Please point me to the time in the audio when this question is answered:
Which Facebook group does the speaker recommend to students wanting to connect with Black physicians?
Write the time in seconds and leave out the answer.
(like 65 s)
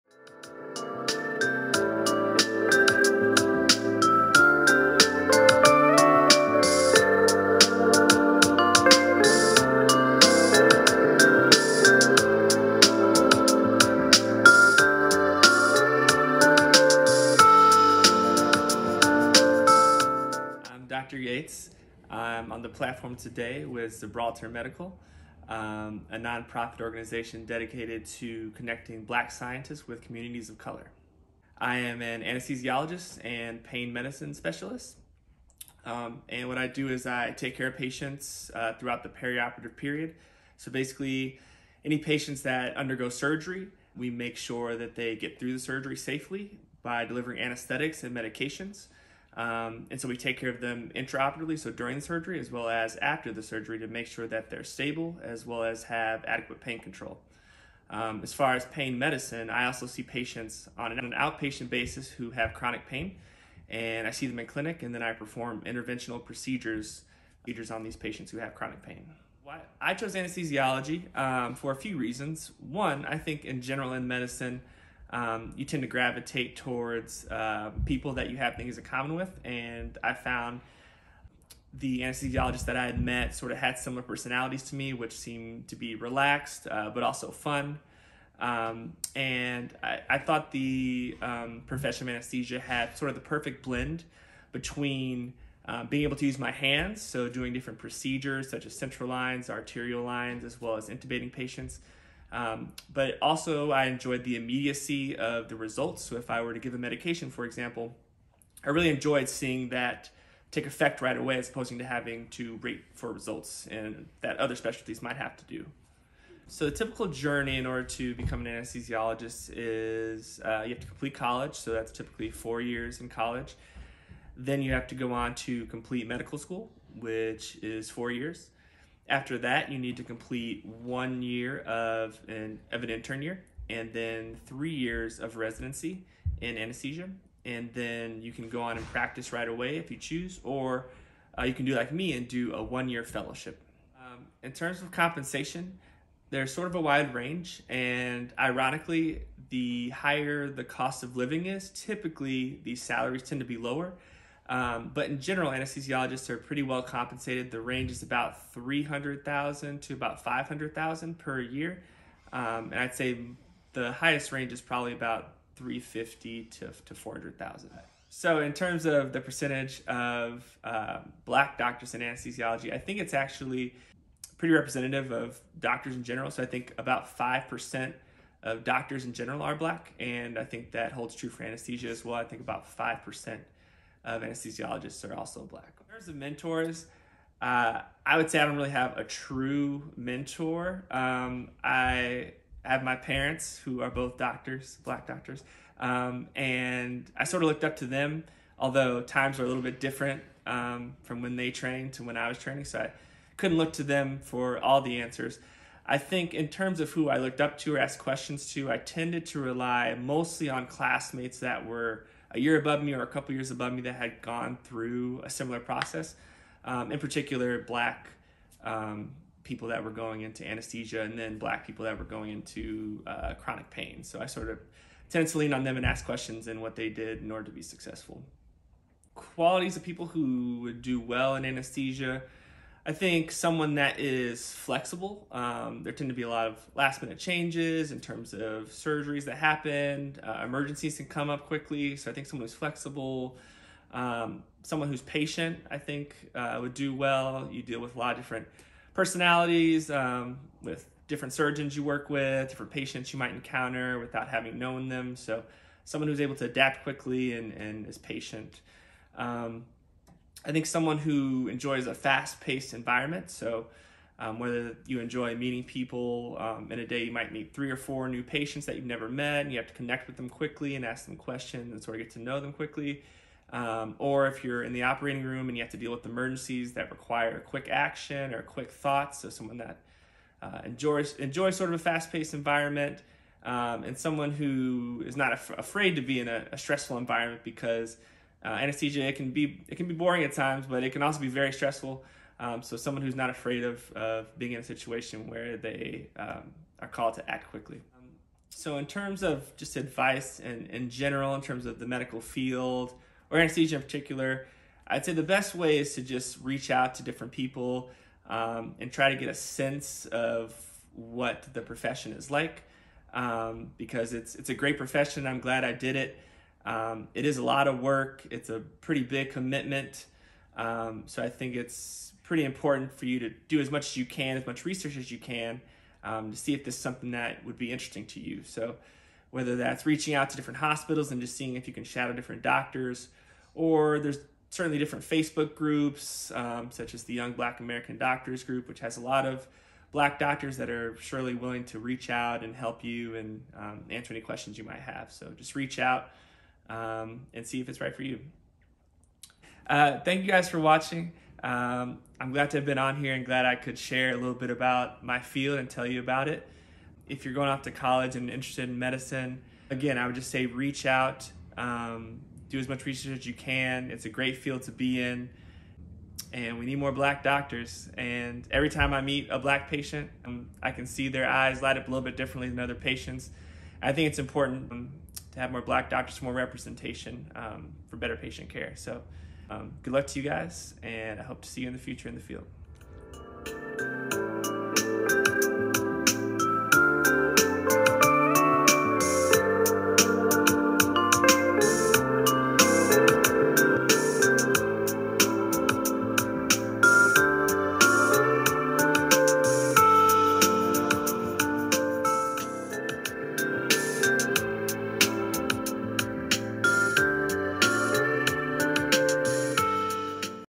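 337 s.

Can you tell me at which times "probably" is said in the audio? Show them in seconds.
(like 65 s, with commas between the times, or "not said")
164 s.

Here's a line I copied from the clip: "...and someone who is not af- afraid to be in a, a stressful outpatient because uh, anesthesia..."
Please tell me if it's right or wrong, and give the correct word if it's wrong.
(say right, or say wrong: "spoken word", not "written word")
wrong: "environment", not "outpatient".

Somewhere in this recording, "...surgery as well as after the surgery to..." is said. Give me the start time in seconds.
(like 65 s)
52 s.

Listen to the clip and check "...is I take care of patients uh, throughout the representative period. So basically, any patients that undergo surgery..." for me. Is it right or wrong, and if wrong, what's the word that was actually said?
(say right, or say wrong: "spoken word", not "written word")
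wrong: "perioperative", not "representative".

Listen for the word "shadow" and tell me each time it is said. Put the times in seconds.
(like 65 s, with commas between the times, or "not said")
331 s.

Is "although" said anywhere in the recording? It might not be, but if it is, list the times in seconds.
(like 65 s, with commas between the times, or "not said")
198 s.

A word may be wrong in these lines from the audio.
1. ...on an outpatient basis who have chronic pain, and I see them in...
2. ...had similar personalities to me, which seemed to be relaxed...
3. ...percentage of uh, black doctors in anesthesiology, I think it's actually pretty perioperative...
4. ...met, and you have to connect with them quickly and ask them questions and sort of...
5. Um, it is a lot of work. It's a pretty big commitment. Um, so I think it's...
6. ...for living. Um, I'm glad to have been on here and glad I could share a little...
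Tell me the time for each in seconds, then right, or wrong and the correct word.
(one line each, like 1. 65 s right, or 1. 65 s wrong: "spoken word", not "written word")
1. 60 s right
2. 83 s right
3. 169 s wrong: "representative", not "perioperative"
4. 269 s right
5. 316 s right
6. 350 s wrong: "watching", not "living".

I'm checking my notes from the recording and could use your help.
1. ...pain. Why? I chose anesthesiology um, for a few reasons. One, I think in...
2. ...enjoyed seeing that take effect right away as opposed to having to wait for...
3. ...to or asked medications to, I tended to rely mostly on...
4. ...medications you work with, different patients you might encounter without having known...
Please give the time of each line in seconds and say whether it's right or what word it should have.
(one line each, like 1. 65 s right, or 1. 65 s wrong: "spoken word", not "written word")
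1. 68 s right
2. 108 s right
3. 207 s wrong: "questions", not "medications"
4. 251 s wrong: "surgeons", not "medications".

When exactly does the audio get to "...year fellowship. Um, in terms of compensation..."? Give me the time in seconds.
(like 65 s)
142 s.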